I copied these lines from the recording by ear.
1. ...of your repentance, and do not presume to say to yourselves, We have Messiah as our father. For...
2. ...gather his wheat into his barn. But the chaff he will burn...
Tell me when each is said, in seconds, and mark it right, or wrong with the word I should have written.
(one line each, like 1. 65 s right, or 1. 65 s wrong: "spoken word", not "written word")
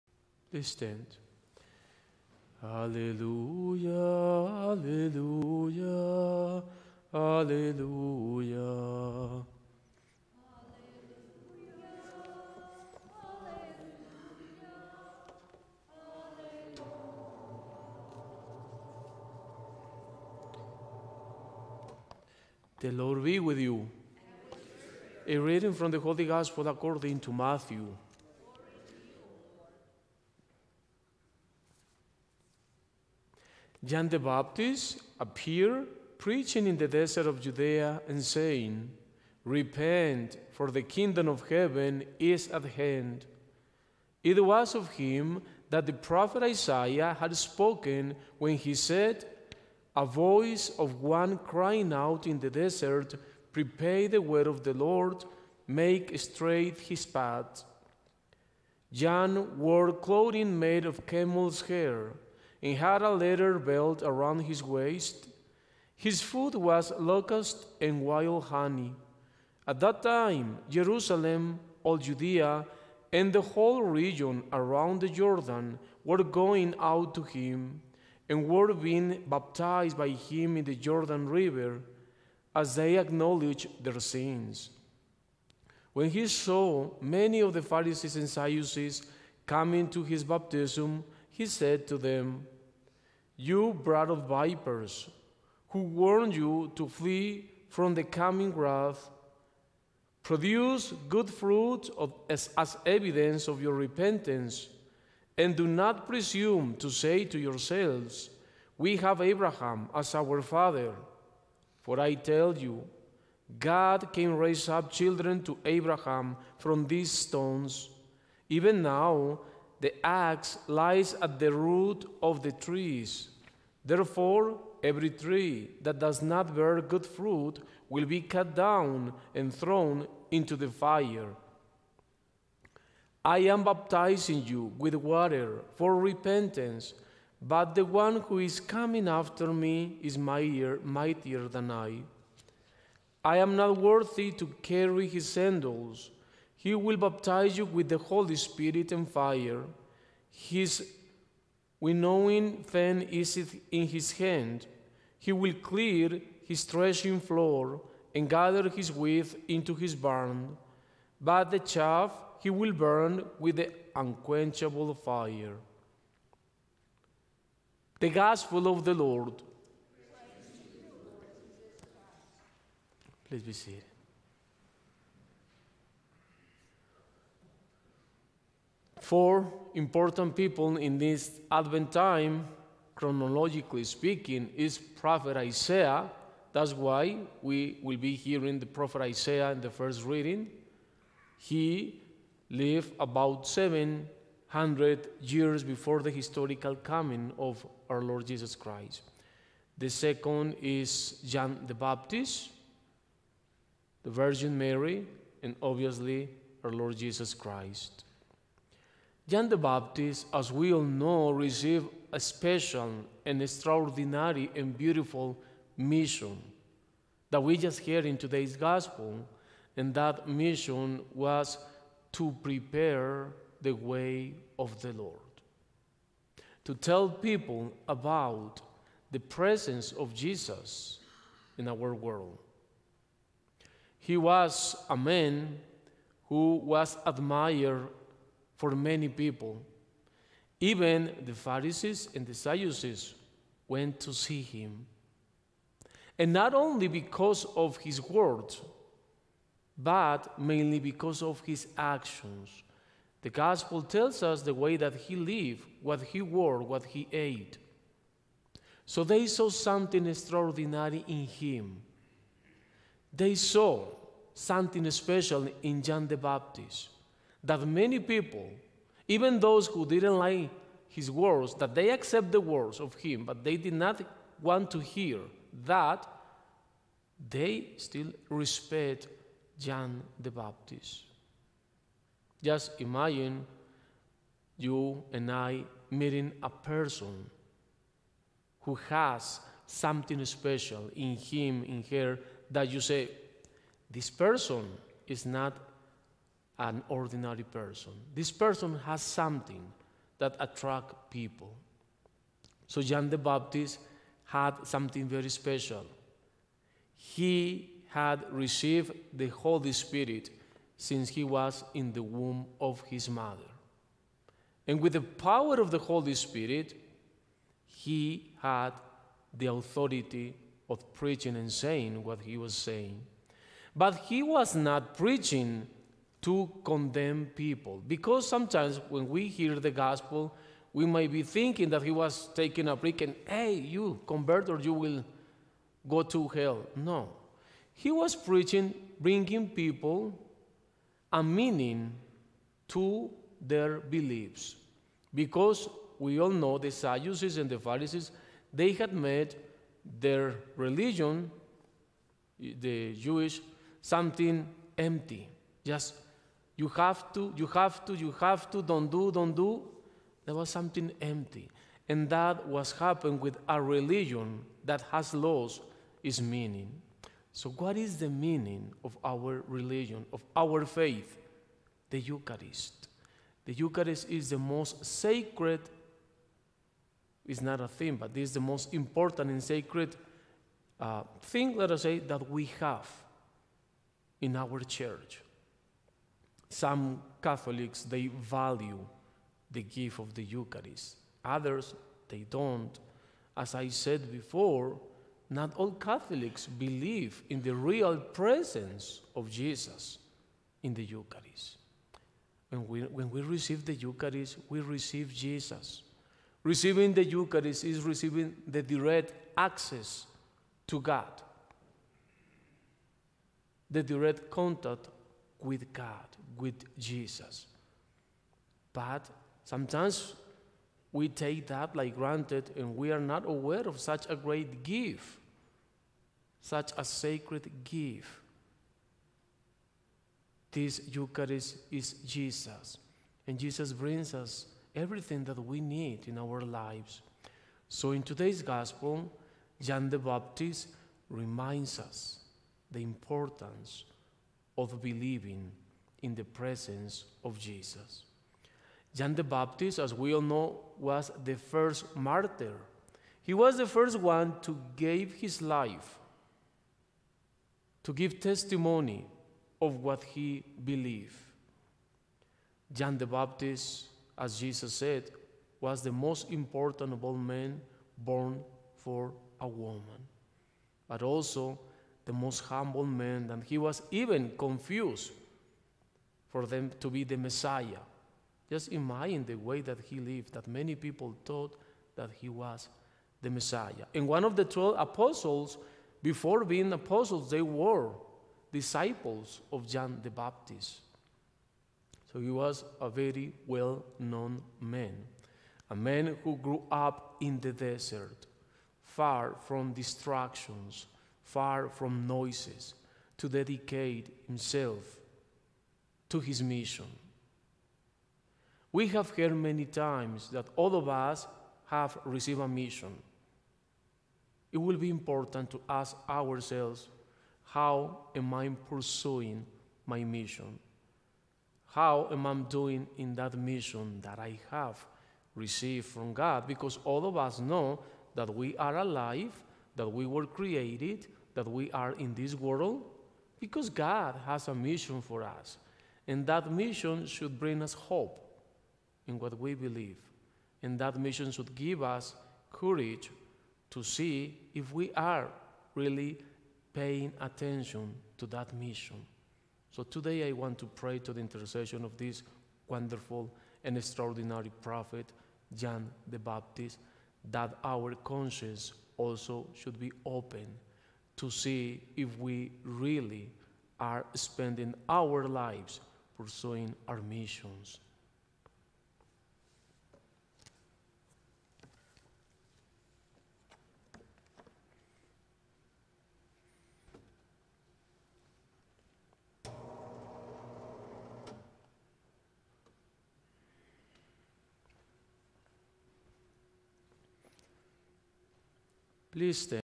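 1. 103 s wrong: "Abraham", not "Messiah"
2. 158 s right.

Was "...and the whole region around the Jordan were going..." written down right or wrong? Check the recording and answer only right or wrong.
right.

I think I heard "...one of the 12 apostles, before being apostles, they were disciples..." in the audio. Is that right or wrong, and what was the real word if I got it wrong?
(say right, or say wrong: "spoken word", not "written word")
right.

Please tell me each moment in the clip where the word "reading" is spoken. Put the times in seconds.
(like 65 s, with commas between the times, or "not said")
25 s, 190 s.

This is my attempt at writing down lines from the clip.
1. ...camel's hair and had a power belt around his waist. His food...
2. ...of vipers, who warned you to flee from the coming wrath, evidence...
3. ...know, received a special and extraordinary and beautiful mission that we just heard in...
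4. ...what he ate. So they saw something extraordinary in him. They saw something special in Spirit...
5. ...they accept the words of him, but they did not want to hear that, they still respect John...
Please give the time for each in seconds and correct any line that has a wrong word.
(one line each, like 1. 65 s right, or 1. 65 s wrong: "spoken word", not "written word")
1. 61 s wrong: "leather", not "power"
2. 93 s wrong: "produce", not "evidence"
3. 210 s right
4. 256 s wrong: "John", not "Spirit"
5. 271 s right.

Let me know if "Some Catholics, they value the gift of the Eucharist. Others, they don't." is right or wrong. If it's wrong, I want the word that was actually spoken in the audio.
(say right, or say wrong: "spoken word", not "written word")
right.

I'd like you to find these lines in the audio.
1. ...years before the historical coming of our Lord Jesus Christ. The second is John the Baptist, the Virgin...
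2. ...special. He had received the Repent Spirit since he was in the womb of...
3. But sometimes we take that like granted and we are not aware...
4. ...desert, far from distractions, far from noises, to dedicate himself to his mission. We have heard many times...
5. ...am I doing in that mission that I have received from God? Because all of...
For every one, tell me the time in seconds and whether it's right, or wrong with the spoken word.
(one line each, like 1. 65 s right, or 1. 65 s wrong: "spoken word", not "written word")
1. 195 s right
2. 305 s wrong: "Holy", not "Repent"
3. 418 s right
4. 497 s right
5. 522 s right.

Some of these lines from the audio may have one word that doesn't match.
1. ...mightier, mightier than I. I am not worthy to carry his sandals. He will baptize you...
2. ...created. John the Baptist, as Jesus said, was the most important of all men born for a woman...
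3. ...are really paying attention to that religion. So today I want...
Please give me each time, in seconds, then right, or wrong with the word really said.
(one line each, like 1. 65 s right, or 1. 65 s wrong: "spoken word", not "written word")
1. 140 s right
2. 460 s wrong: "believed", not "created"
3. 544 s wrong: "mission", not "religion".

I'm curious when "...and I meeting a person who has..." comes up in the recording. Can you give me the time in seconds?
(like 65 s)
285 s.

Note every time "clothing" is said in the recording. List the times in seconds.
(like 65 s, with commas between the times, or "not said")
59 s.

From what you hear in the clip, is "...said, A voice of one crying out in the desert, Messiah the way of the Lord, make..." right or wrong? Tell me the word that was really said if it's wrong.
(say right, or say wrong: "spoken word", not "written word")
wrong: "Prepare", not "Messiah".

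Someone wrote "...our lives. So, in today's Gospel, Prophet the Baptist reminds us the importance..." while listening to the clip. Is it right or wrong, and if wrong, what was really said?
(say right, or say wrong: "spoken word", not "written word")
wrong: "John", not "Prophet".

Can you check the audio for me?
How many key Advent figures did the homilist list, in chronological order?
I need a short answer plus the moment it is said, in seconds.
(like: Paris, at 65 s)
four, at 179 s.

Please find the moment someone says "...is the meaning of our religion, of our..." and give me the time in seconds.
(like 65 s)
367 s.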